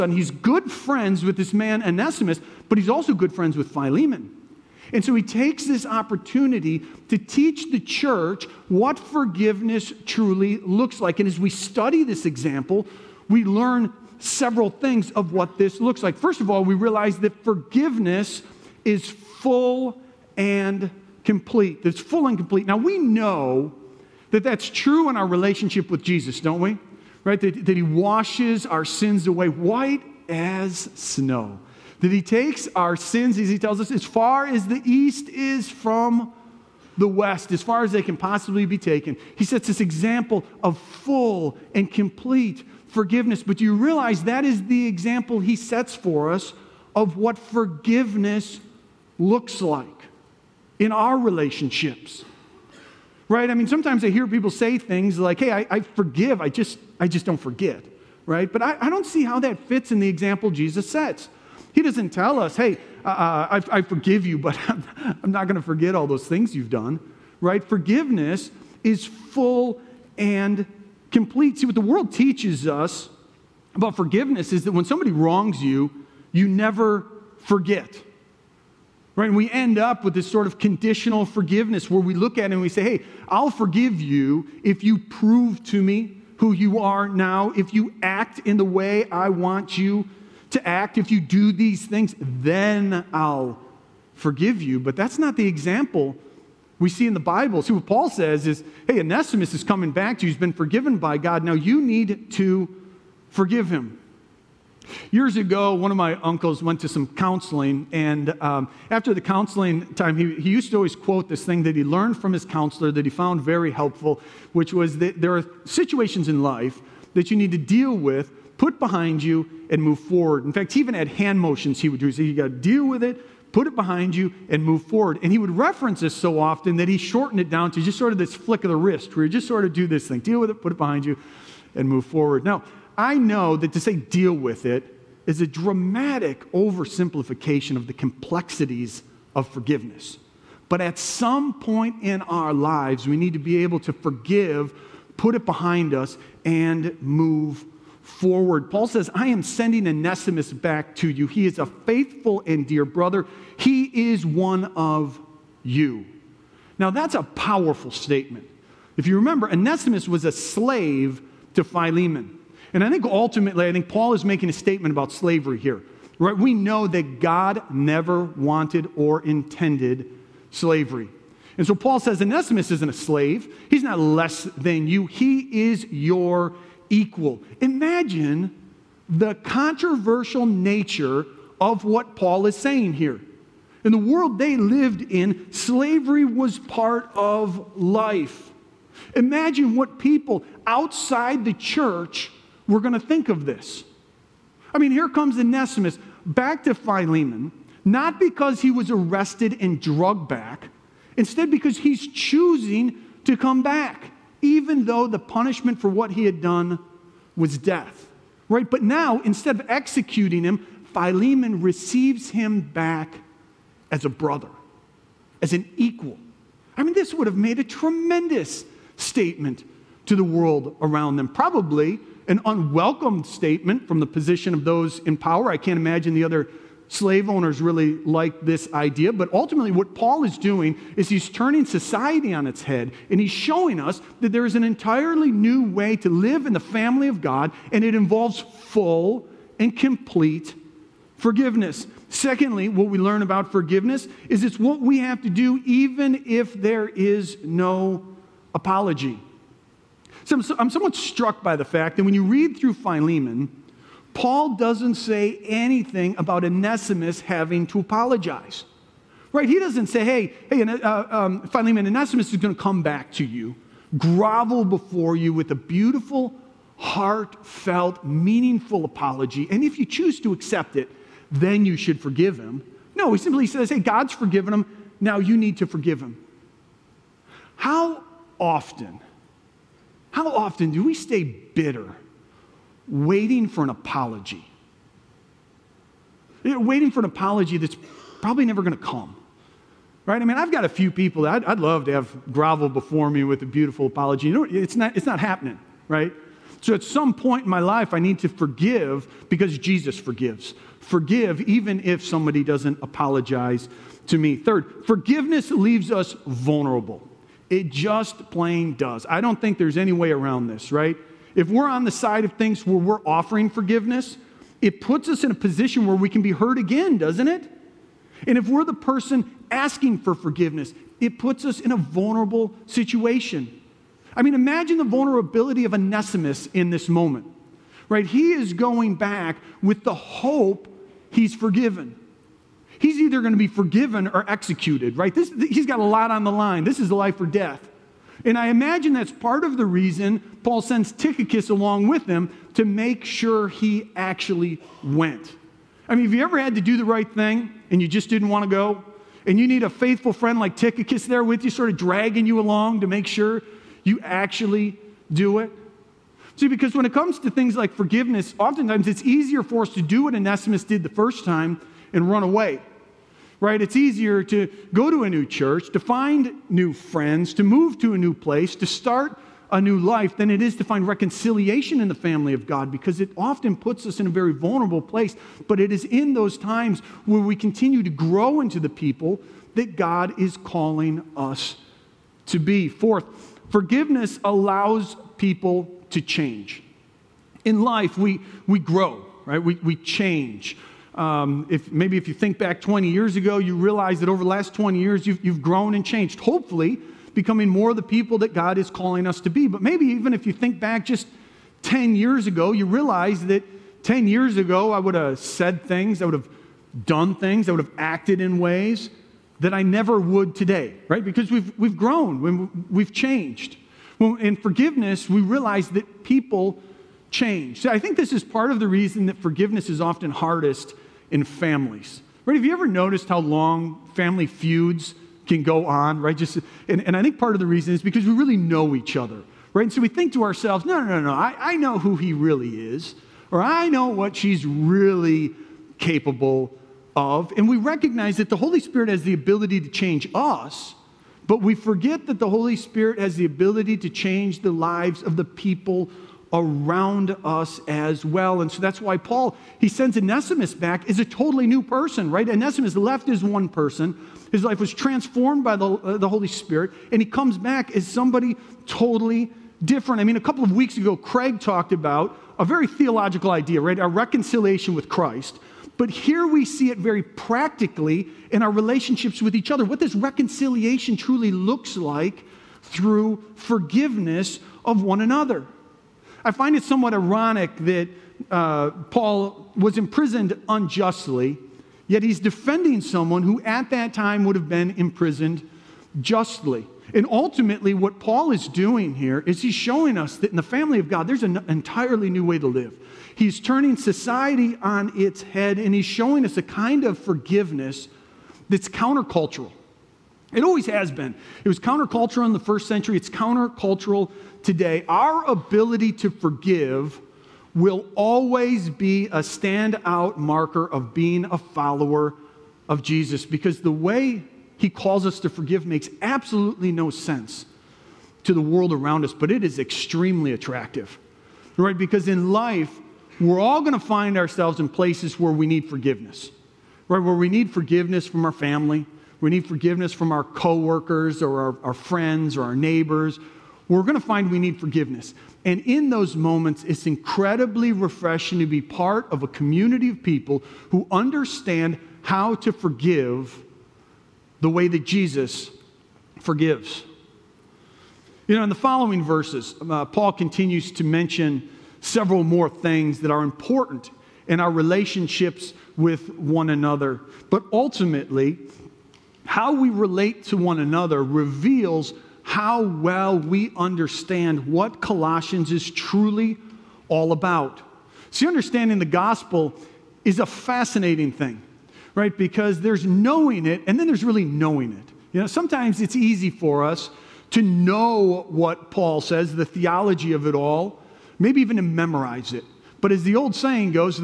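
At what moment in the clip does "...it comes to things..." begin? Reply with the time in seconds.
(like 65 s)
356 s.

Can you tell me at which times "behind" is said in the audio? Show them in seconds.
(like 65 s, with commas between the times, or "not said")
118 s, 123 s, 130 s, 145 s.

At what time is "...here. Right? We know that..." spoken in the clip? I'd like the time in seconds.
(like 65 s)
165 s.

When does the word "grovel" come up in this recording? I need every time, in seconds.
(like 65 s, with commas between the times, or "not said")
263 s, 292 s.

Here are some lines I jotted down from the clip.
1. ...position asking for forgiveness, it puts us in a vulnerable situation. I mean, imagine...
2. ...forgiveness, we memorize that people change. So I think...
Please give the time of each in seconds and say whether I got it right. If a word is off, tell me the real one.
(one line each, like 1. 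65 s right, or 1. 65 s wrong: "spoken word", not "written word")
1. 318 s wrong: "person", not "position"
2. 414 s wrong: "realize", not "memorize".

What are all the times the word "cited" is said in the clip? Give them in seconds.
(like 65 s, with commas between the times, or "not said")
not said.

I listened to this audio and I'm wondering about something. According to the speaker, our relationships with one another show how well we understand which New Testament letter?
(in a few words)
Colossians.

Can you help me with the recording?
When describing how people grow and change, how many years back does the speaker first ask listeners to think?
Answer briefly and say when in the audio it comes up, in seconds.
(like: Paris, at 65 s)
20, at 392 s.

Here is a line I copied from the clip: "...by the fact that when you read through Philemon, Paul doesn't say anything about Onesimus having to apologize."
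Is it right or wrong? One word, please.
right.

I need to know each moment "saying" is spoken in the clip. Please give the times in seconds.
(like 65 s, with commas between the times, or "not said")
182 s, 583 s.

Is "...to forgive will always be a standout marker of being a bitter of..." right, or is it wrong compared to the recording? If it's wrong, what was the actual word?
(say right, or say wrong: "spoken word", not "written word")
wrong: "follower", not "bitter".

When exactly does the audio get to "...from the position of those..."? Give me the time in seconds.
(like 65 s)
223 s.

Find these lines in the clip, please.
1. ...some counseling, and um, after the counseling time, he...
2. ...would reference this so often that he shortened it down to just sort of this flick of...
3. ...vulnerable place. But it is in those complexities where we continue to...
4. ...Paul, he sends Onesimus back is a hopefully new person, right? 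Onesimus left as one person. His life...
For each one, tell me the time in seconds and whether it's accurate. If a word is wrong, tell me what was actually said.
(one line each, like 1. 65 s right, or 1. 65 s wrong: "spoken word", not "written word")
1. 106 s right
2. 125 s right
3. 374 s wrong: "times", not "complexities"
4. 448 s wrong: "totally", not "hopefully".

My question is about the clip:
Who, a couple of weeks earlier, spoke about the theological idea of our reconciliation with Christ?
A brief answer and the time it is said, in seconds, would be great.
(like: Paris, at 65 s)
Craig, at 460 s.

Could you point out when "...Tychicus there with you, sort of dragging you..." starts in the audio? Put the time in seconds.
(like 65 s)
350 s.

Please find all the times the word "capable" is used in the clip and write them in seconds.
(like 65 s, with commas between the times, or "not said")
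435 s.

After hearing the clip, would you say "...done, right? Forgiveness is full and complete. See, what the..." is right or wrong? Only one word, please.
right.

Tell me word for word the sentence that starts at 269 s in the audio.
And if you choose to accept it, then you should forgive him.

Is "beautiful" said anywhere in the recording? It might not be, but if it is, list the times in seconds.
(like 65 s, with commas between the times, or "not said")
265 s, 293 s.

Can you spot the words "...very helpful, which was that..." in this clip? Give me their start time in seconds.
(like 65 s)
113 s.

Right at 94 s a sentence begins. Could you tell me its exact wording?
But that's not the example we see in the Bible.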